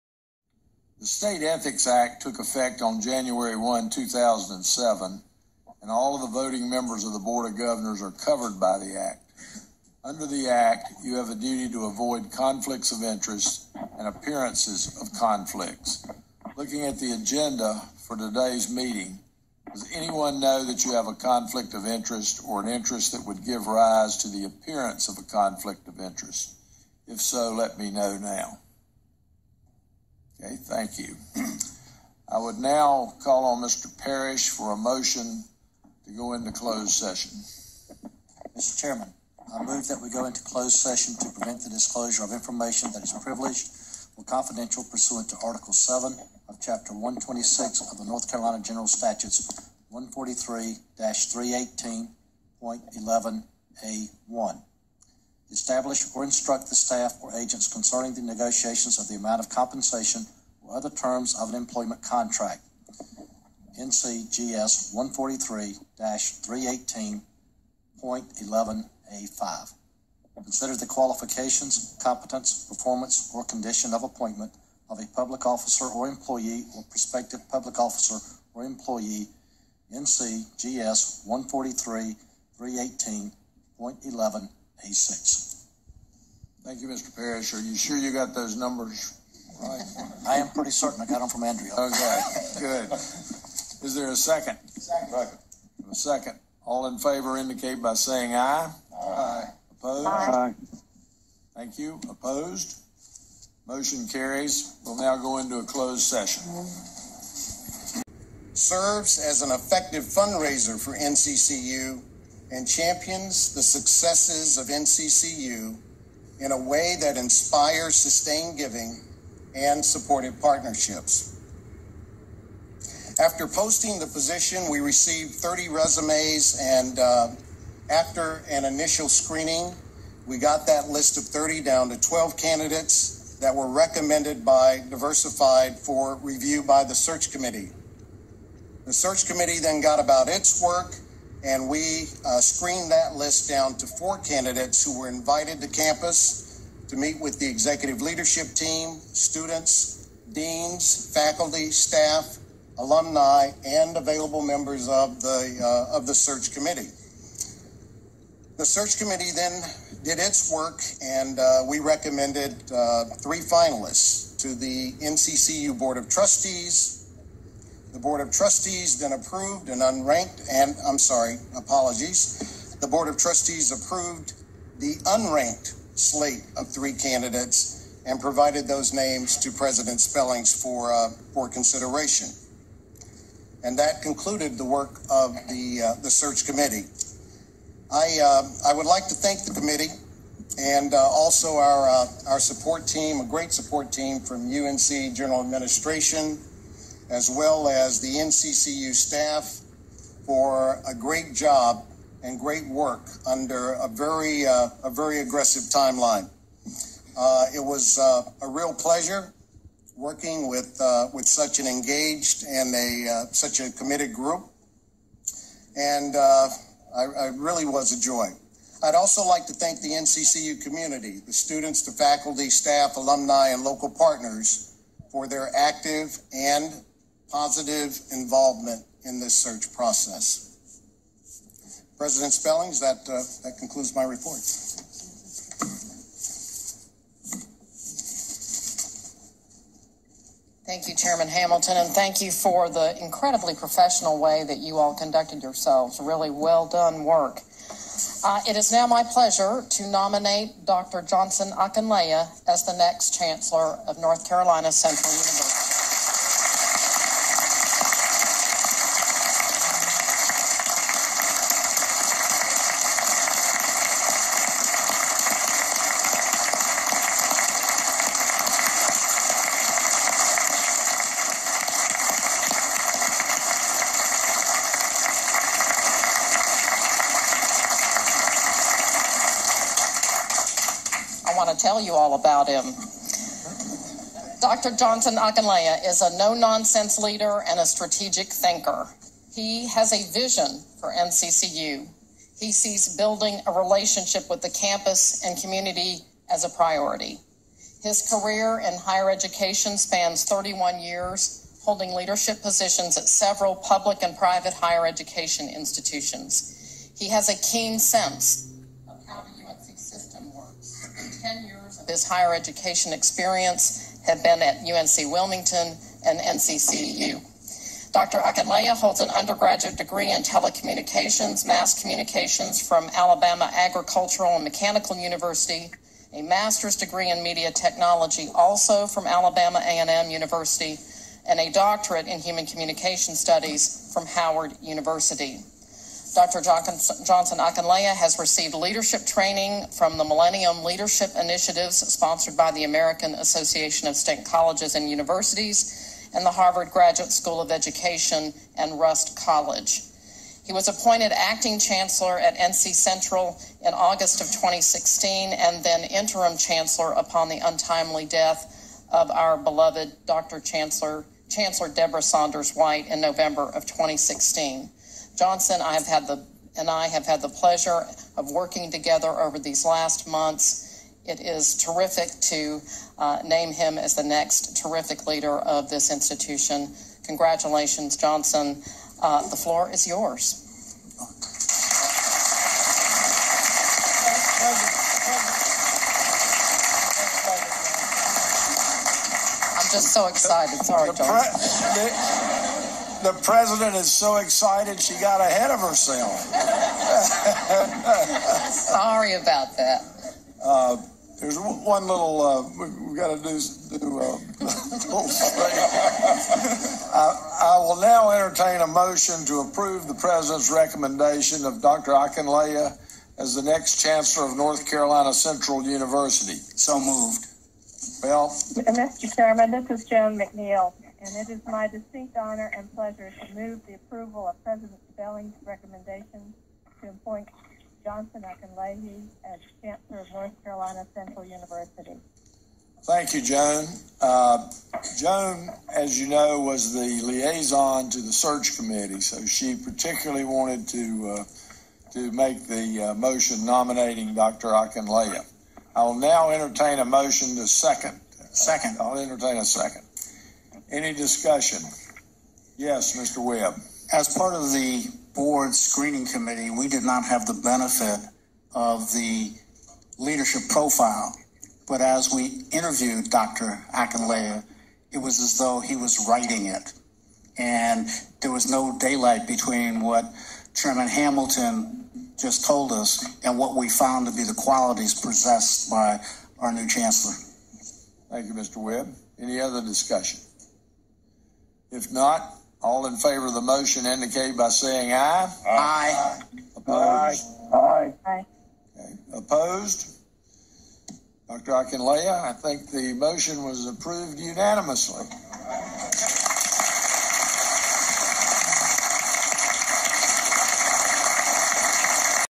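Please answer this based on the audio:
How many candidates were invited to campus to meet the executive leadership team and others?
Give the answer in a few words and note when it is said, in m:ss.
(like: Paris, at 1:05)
4, at 2:23.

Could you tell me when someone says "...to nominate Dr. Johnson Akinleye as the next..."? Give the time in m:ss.
4:09.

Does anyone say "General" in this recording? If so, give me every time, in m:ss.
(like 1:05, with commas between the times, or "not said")
0:48, 3:15.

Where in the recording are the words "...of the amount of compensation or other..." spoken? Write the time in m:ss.
0:58.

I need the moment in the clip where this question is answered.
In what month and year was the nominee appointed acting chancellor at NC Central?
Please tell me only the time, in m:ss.
5:53.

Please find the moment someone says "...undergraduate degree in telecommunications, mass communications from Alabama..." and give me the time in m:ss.
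5:19.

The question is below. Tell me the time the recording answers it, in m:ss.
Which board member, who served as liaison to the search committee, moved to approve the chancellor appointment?
6:59.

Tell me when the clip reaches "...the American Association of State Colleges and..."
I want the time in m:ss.
5:42.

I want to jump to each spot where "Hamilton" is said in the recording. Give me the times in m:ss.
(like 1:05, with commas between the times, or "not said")
4:01, 7:50.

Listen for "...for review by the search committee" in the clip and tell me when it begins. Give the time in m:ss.
2:15.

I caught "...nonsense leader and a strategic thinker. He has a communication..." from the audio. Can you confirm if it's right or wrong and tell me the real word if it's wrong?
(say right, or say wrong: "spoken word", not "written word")
wrong: "vision", not "communication".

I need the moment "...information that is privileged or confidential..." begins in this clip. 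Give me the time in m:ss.
0:42.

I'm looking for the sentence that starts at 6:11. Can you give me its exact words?
It is terrific to uh, name him as the next terrific leader of this institution.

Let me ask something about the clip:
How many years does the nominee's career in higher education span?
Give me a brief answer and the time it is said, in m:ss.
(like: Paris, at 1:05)
31, at 5:00.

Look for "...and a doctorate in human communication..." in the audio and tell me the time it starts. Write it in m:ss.
5:31.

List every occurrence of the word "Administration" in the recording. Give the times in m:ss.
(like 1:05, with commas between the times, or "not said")
3:15.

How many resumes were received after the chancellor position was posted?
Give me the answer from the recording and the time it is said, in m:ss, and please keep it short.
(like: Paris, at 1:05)
30, at 2:05.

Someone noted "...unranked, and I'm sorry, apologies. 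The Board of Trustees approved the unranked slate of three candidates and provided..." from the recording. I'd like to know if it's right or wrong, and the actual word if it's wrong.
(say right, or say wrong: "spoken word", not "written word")
right.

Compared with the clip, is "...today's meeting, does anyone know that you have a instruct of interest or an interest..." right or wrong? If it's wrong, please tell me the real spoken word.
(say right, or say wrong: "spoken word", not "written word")
wrong: "conflict", not "instruct".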